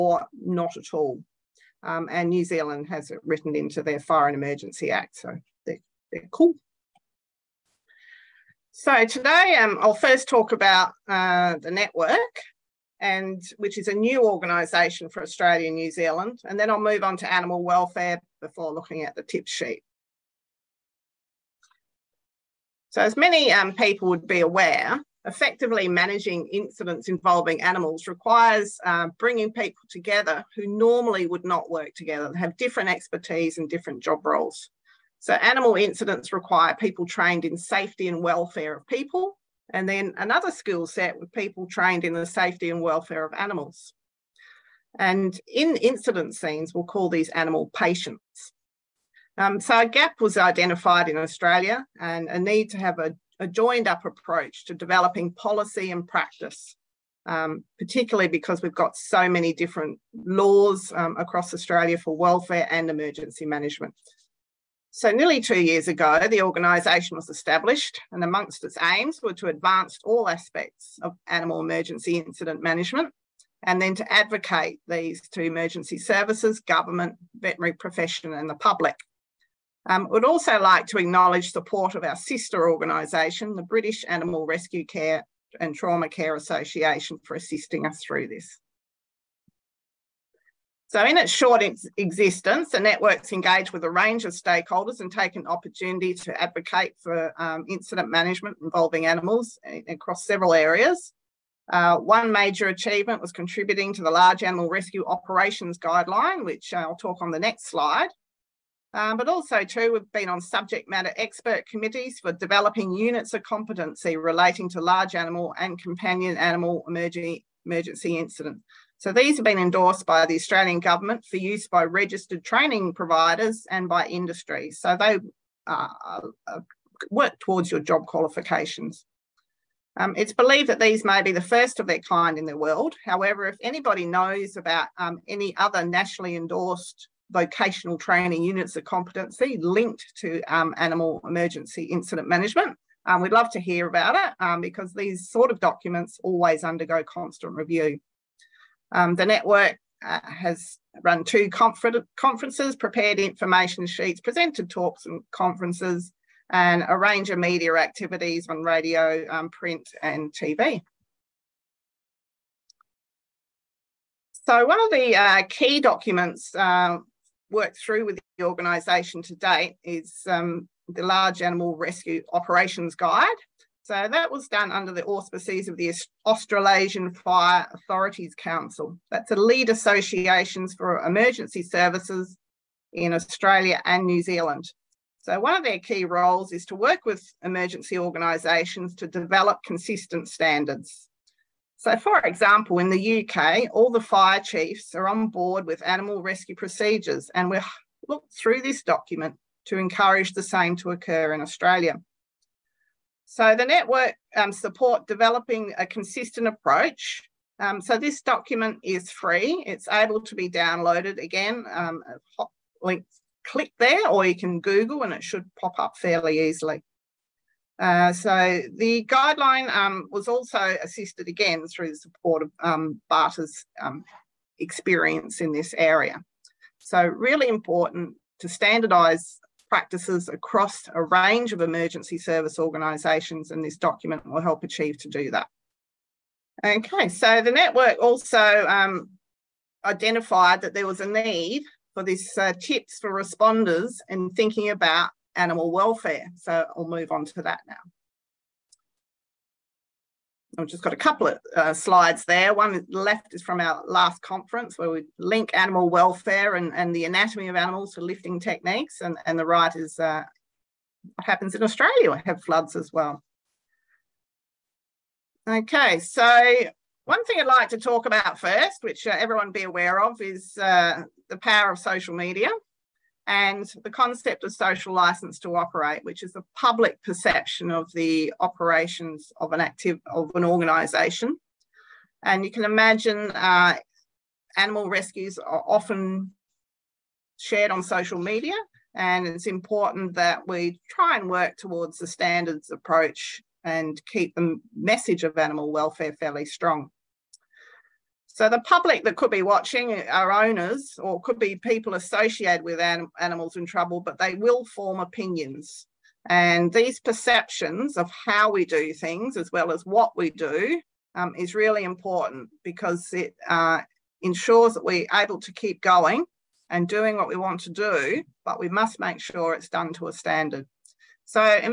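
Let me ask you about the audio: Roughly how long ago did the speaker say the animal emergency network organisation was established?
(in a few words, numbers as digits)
nearly 2 years ago.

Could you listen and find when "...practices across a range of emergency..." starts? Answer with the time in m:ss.
3:49.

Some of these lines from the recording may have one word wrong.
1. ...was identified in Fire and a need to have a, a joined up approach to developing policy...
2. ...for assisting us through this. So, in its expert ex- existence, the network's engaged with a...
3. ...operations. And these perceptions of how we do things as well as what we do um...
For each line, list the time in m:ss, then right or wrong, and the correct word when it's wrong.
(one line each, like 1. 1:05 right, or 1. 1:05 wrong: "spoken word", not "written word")
1. 0:50 wrong: "Australia", not "Fire"
2. 1:27 wrong: "short", not "expert"
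3. 5:05 wrong: "opinions", not "operations".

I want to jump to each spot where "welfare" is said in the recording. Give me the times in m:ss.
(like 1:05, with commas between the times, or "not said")
0:17, 0:38, 0:42, 1:02, 4:05, 4:15, 4:55.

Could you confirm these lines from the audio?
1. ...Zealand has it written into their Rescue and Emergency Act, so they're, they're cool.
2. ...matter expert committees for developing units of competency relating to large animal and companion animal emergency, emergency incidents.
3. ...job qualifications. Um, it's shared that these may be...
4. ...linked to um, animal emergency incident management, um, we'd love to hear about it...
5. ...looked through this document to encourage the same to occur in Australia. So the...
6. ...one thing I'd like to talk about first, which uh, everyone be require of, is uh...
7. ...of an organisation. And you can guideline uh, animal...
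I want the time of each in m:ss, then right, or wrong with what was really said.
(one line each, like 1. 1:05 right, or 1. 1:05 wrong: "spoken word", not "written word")
1. 0:02 wrong: "Fire", not "Rescue"
2. 1:50 right
3. 2:07 wrong: "believed", not "shared"
4. 2:19 right
5. 3:18 right
6. 4:27 wrong: "aware", not "require"
7. 4:40 wrong: "imagine", not "guideline".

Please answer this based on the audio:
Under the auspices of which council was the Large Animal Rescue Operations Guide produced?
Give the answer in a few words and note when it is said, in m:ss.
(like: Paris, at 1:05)
Australasian Fire Authorities Council, at 2:56.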